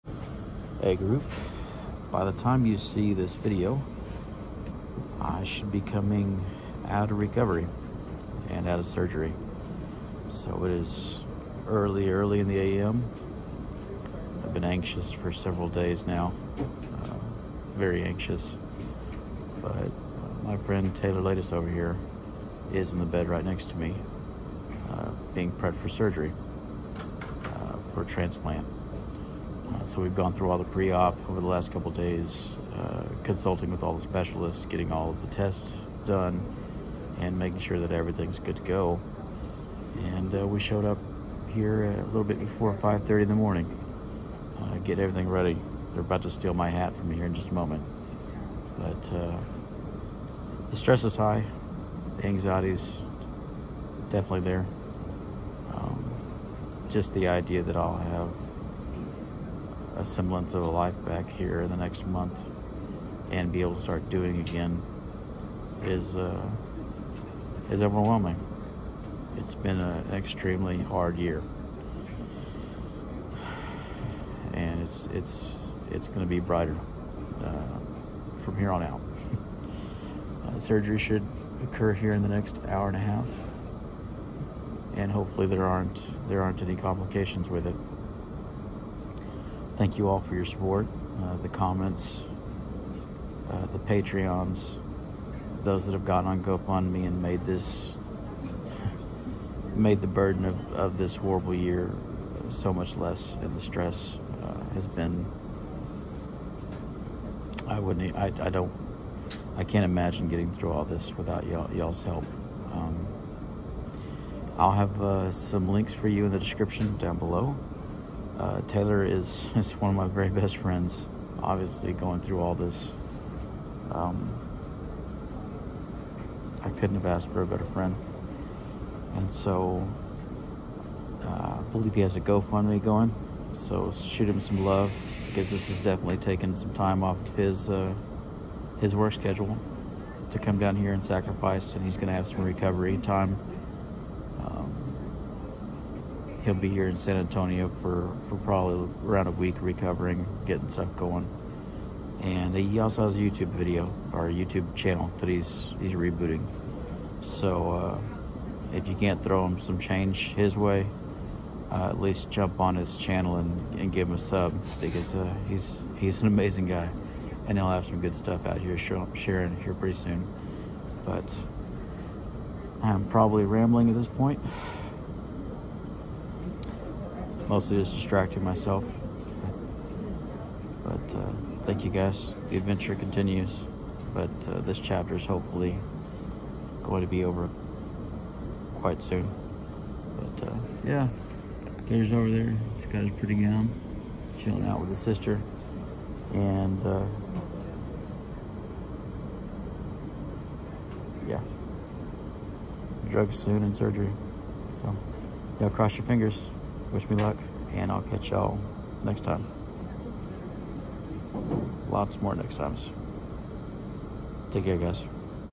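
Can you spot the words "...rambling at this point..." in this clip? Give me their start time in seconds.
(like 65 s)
173 s.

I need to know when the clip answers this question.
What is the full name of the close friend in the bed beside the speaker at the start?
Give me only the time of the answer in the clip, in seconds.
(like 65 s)
20 s.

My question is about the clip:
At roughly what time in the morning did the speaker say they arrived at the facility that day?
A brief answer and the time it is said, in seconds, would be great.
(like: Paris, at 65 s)
5:30, at 42 s.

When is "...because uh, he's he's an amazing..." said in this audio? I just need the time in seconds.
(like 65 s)
164 s.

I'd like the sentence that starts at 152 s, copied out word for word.
And he also has a YouTube video or YouTube channel that he's he's rebooting.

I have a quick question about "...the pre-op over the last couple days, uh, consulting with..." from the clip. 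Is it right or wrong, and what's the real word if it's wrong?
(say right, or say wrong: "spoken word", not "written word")
right.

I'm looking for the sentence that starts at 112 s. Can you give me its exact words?
Um, I'll have uh, some links for you in the description down below.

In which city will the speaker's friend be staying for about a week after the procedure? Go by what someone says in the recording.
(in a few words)
San Antonio.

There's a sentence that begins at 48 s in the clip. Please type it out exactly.
But uh, the stress is high, the anxiety's definitely there.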